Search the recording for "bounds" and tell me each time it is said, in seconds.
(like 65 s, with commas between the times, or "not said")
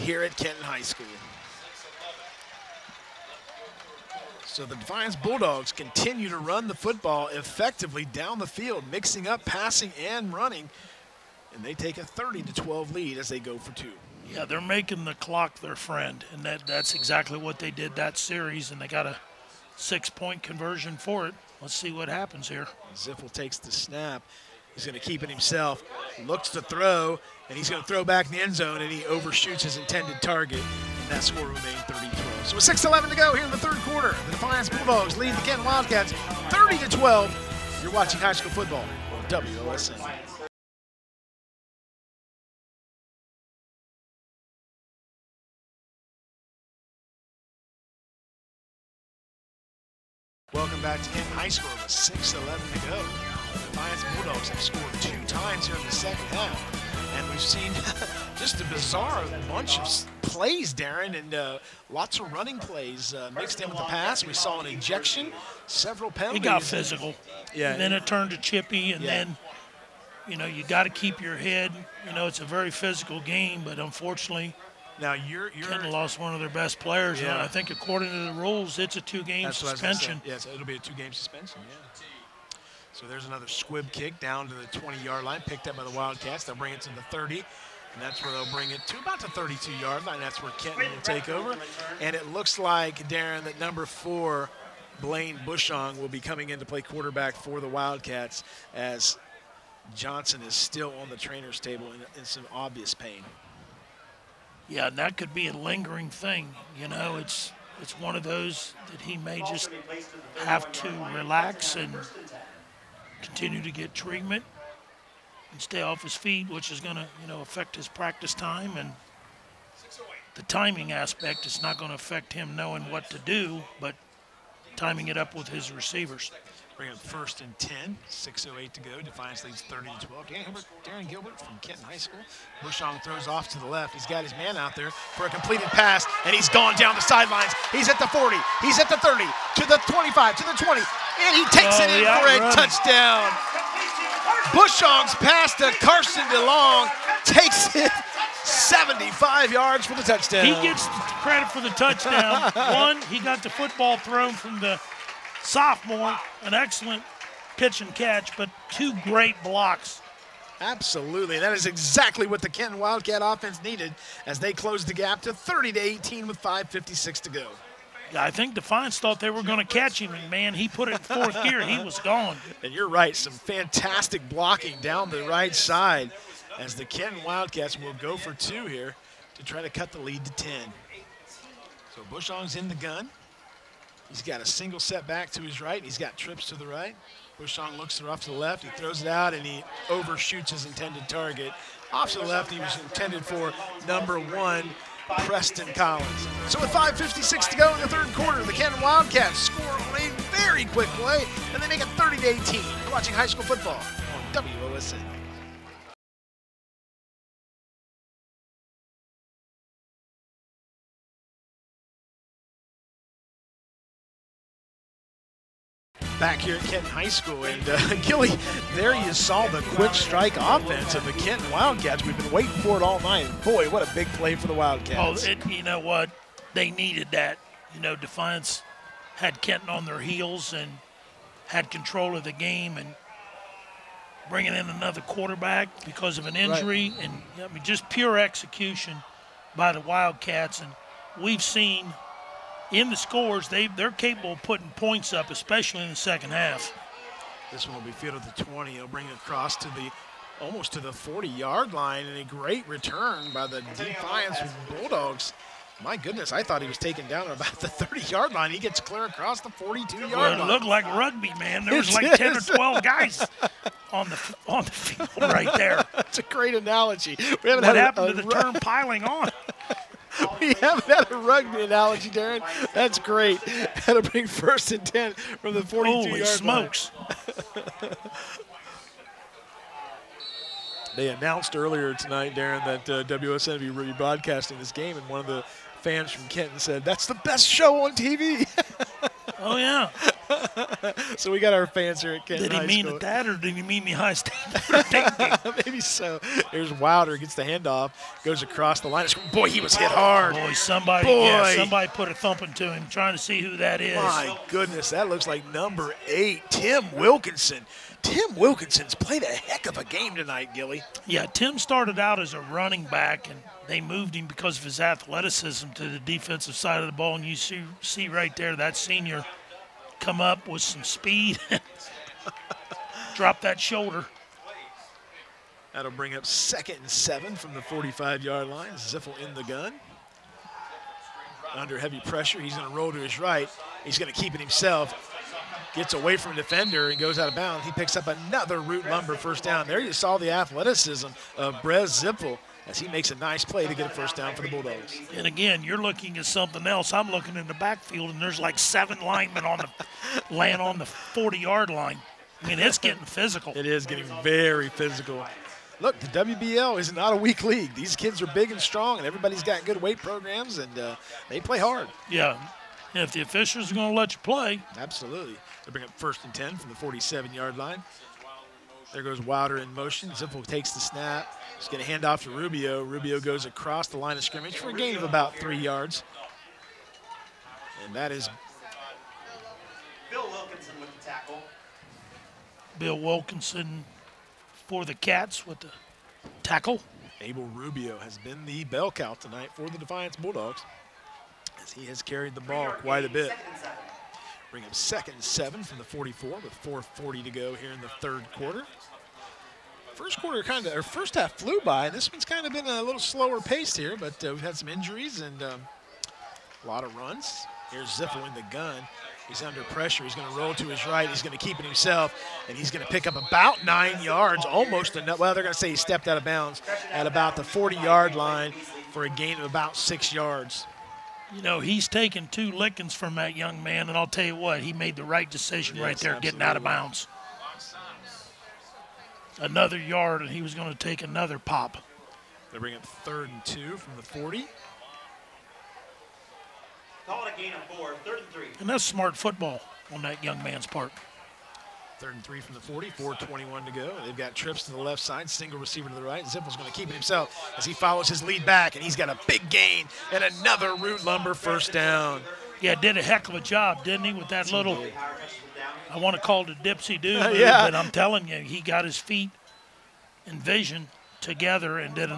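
337 s, 416 s, 426 s.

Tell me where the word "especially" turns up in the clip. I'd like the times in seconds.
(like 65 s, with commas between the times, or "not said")
245 s.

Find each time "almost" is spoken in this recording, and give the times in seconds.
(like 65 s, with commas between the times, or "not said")
250 s, 414 s.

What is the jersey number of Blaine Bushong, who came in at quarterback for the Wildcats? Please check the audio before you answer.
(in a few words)
4.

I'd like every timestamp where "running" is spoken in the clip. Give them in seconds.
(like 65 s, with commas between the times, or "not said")
10 s, 62 s, 312 s.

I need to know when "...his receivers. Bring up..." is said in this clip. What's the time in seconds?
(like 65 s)
125 s.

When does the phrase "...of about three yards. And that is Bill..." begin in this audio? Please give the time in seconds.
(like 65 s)
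374 s.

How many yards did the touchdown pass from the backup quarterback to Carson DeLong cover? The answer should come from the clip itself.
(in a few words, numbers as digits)
75.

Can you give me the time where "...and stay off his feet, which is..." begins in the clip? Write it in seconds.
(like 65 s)
115 s.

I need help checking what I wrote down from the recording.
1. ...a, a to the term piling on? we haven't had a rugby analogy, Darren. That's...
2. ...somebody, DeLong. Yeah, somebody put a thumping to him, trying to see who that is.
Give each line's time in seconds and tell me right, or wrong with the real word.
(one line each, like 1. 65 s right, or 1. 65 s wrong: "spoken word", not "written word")
1. 268 s right
2. 300 s wrong: "Boy", not "DeLong".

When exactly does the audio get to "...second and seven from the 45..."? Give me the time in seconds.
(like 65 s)
326 s.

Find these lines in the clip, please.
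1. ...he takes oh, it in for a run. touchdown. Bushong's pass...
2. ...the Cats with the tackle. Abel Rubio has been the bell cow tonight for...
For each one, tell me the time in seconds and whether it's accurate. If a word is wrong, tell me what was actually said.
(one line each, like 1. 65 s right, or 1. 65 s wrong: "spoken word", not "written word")
1. 141 s right
2. 384 s right.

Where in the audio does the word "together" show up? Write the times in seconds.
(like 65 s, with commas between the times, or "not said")
461 s.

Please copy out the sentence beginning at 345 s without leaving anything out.
And again, you're looking at something else.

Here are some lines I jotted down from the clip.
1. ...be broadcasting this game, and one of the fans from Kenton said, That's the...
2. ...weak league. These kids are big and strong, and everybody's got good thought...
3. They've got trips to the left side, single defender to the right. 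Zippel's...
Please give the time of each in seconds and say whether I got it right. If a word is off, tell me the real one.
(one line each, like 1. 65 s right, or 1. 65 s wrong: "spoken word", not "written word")
1. 283 s right
2. 357 s wrong: "weight", not "thought"
3. 444 s wrong: "receiver", not "defender".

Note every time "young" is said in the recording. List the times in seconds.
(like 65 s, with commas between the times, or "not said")
423 s, 440 s.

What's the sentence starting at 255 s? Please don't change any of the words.
My goodness, I thought he was taken down at about the 30-yard line.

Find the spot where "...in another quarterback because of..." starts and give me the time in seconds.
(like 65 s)
234 s.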